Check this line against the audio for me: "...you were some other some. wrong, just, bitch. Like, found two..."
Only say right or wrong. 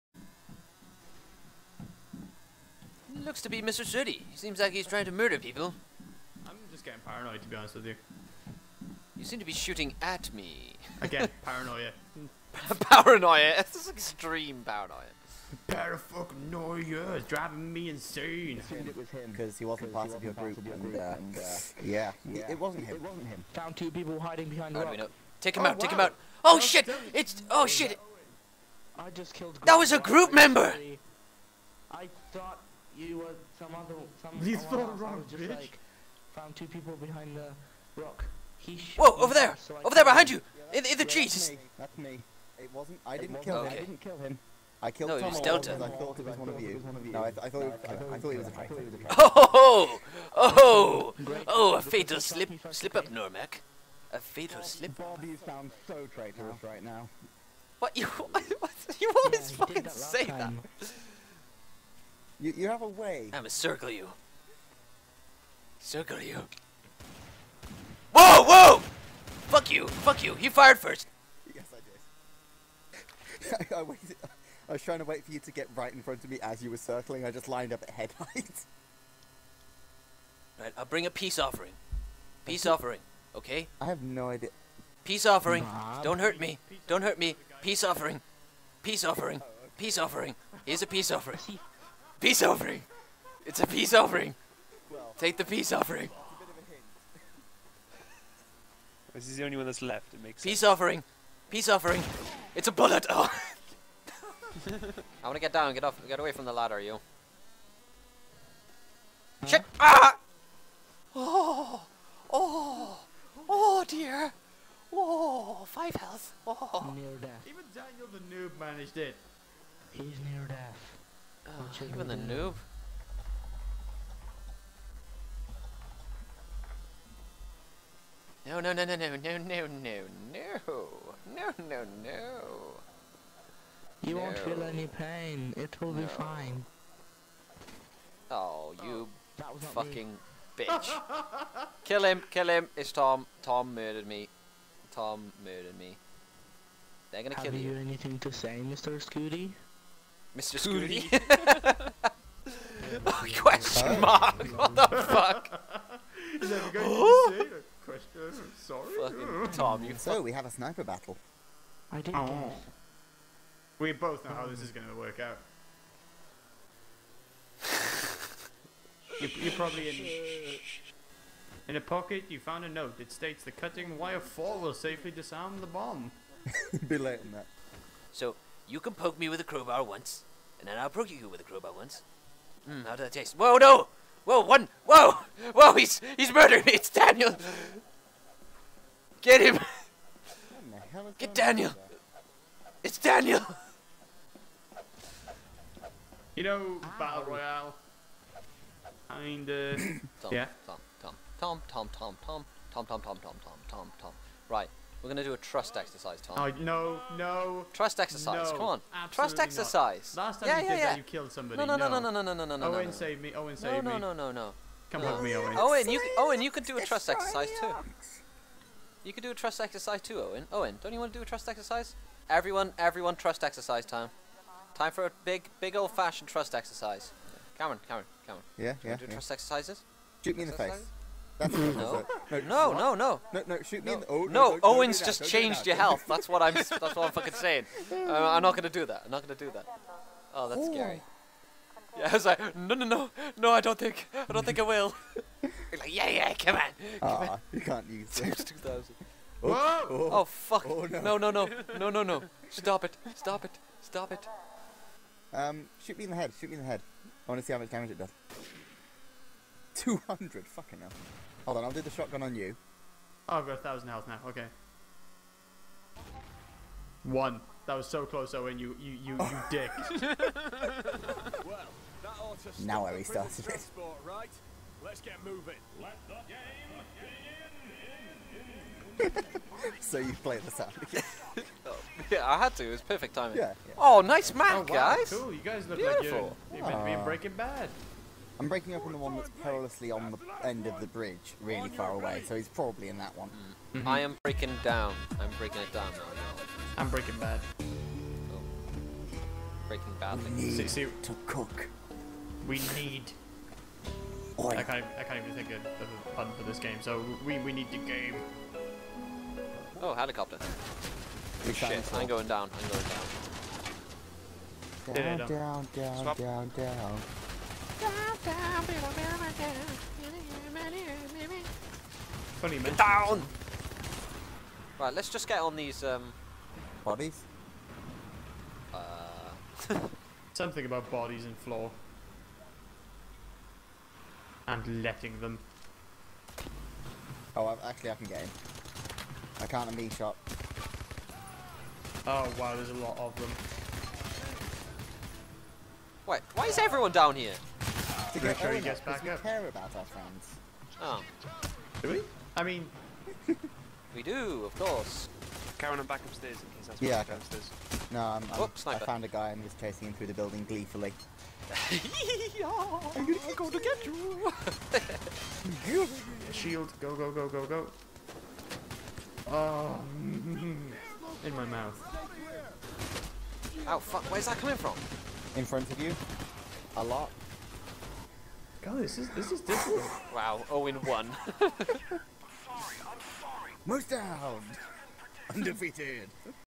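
right.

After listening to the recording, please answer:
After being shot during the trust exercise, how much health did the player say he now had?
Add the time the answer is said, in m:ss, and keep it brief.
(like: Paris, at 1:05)
1000, at 4:23.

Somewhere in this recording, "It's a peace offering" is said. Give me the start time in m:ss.
1:33.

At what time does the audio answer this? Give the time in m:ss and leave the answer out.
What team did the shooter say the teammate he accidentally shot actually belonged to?
0:45.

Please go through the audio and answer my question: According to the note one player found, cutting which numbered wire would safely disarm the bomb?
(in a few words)
4.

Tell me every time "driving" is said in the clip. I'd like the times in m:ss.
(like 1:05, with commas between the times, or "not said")
0:17.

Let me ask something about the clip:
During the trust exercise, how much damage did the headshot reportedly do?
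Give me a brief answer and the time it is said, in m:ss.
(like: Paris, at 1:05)
200, at 4:19.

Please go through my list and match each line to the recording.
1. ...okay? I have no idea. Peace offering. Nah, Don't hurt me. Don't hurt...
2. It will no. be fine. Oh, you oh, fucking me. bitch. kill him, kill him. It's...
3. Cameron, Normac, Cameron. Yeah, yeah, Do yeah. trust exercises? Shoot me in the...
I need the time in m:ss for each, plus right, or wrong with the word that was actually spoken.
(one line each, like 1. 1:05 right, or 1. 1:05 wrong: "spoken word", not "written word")
1. 1:23 right
2. 2:15 right
3. 3:47 wrong: "Cameron", not "Normac".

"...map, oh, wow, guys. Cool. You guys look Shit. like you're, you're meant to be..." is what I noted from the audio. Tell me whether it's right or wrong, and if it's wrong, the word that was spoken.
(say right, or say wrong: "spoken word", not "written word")
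wrong: "Beautiful", not "Shit".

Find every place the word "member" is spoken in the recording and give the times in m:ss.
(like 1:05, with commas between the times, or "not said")
0:30.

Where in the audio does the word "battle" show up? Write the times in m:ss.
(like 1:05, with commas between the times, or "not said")
2:40, 3:16.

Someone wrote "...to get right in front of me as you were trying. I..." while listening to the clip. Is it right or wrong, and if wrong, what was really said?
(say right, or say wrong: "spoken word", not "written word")
wrong: "circling", not "trying".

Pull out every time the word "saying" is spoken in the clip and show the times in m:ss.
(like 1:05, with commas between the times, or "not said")
3:57.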